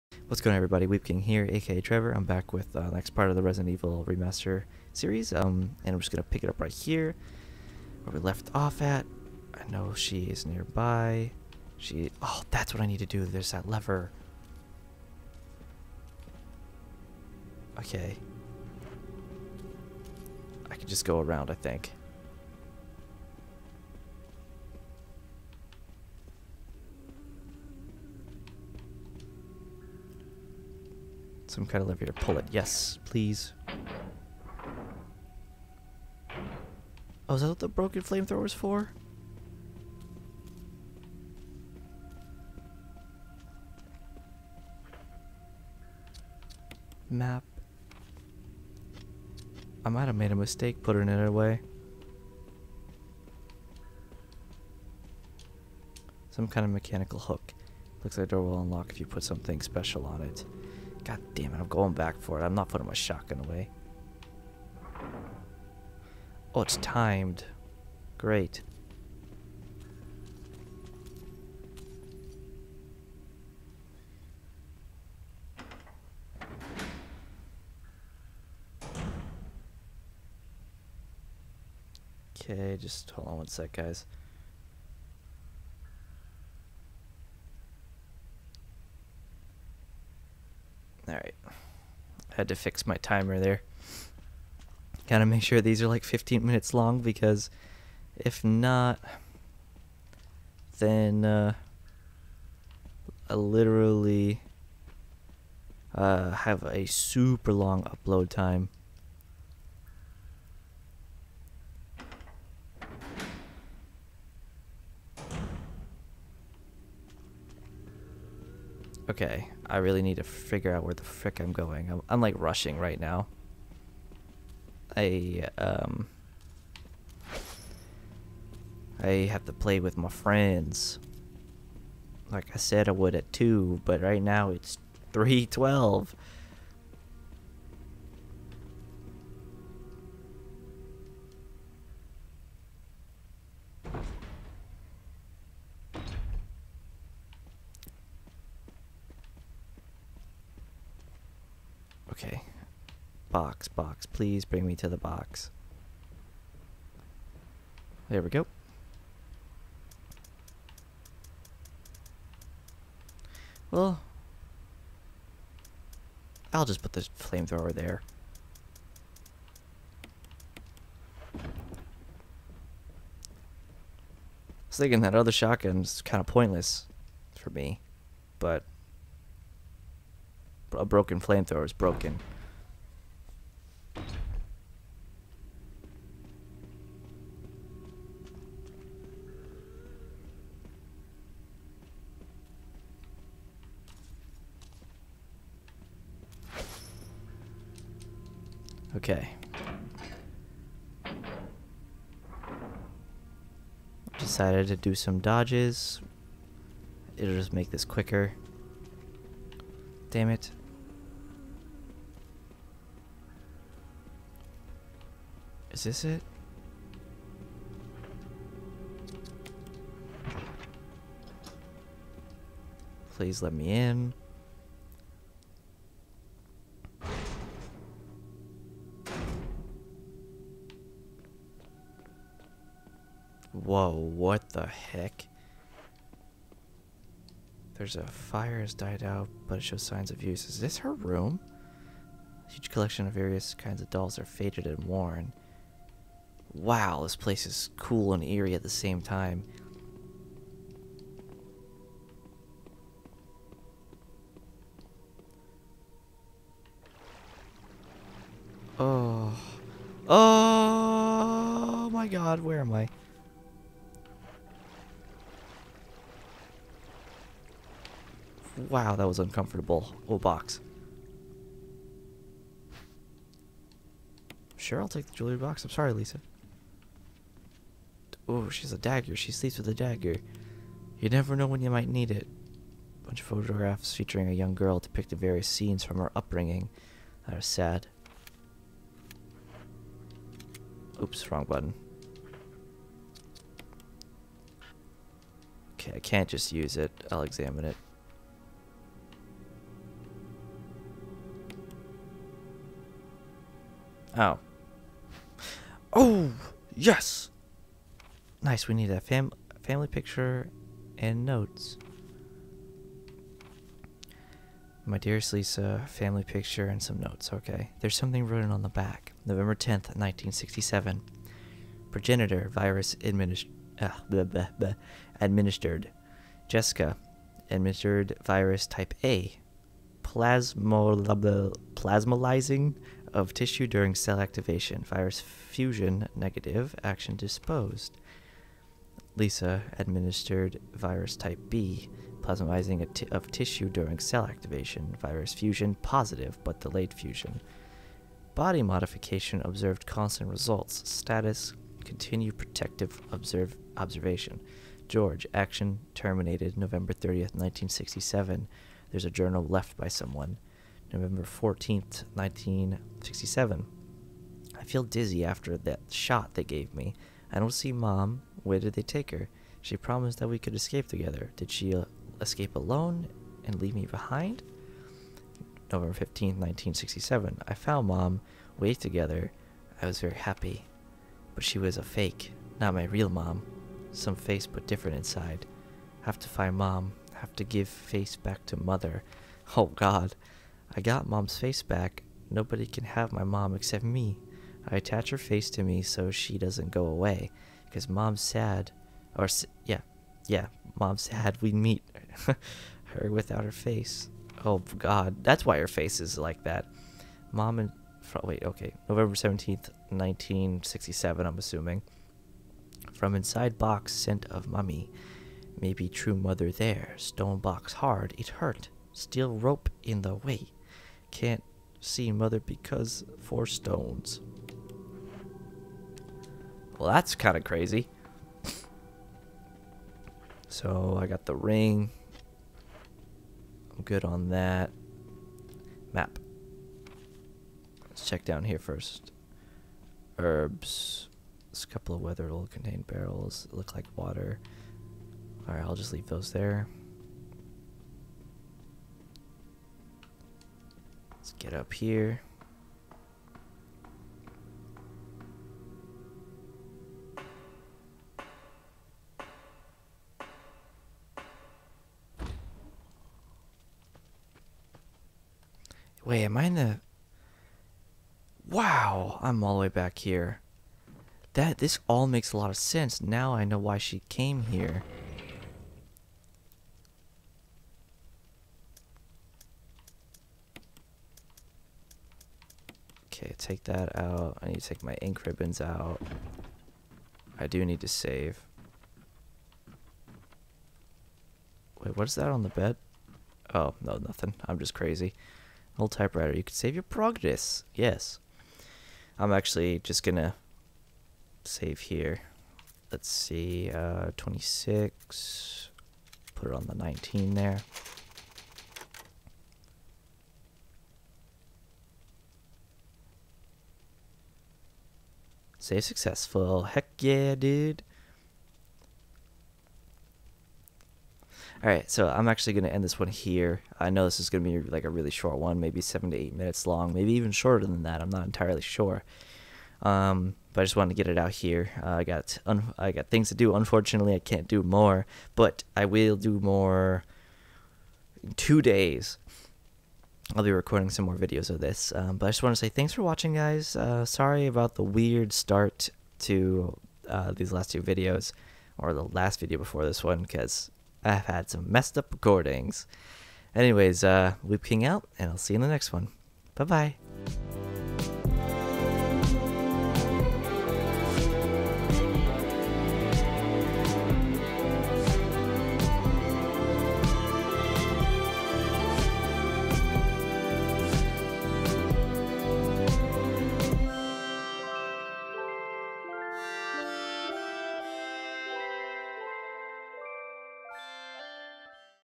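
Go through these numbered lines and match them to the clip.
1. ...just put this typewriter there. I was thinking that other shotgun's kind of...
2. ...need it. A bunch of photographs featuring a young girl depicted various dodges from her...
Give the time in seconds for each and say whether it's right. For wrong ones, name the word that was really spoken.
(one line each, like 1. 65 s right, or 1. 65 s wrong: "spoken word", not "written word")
1. 166 s wrong: "flamethrower", not "typewriter"
2. 281 s wrong: "scenes", not "dodges".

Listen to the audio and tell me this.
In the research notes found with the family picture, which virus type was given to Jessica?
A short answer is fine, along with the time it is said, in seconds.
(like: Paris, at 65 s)
Type A, at 328 s.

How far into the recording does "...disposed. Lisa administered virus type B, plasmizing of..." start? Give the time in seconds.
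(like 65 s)
337 s.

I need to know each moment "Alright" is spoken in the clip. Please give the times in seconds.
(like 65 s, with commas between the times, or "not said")
445 s, 521 s.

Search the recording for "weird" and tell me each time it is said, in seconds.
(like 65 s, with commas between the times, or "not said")
544 s.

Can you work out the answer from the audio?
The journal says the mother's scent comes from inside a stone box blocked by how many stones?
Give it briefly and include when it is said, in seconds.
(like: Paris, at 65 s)
4, at 423 s.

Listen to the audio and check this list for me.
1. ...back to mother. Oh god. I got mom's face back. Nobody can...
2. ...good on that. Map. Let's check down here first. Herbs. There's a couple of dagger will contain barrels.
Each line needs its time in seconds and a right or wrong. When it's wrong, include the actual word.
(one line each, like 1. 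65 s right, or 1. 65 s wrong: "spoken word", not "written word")
1. 388 s right
2. 433 s wrong: "weather", not "dagger".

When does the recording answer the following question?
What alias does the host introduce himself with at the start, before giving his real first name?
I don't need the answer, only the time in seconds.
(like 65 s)
0 s.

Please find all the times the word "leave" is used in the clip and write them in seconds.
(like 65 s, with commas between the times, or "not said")
373 s, 445 s.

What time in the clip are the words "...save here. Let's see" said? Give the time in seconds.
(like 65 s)
501 s.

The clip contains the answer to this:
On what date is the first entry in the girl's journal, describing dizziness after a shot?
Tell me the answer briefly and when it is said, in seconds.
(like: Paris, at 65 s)
November 14th, 1967, at 360 s.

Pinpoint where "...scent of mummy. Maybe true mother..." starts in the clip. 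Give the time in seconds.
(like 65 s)
413 s.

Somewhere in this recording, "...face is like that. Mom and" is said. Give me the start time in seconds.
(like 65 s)
405 s.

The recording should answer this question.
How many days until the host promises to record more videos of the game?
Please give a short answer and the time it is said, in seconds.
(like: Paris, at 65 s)
2, at 538 s.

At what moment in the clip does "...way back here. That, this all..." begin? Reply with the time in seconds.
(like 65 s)
469 s.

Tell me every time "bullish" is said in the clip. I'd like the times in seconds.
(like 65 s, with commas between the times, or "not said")
not said.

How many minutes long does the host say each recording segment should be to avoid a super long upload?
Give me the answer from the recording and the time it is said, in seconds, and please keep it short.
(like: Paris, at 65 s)
15, at 96 s.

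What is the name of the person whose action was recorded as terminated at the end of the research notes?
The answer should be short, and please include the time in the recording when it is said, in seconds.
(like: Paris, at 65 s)
George, at 354 s.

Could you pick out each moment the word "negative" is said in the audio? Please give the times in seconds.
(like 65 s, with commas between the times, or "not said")
336 s.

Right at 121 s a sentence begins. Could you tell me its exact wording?
I'm, I'm like rushing right now.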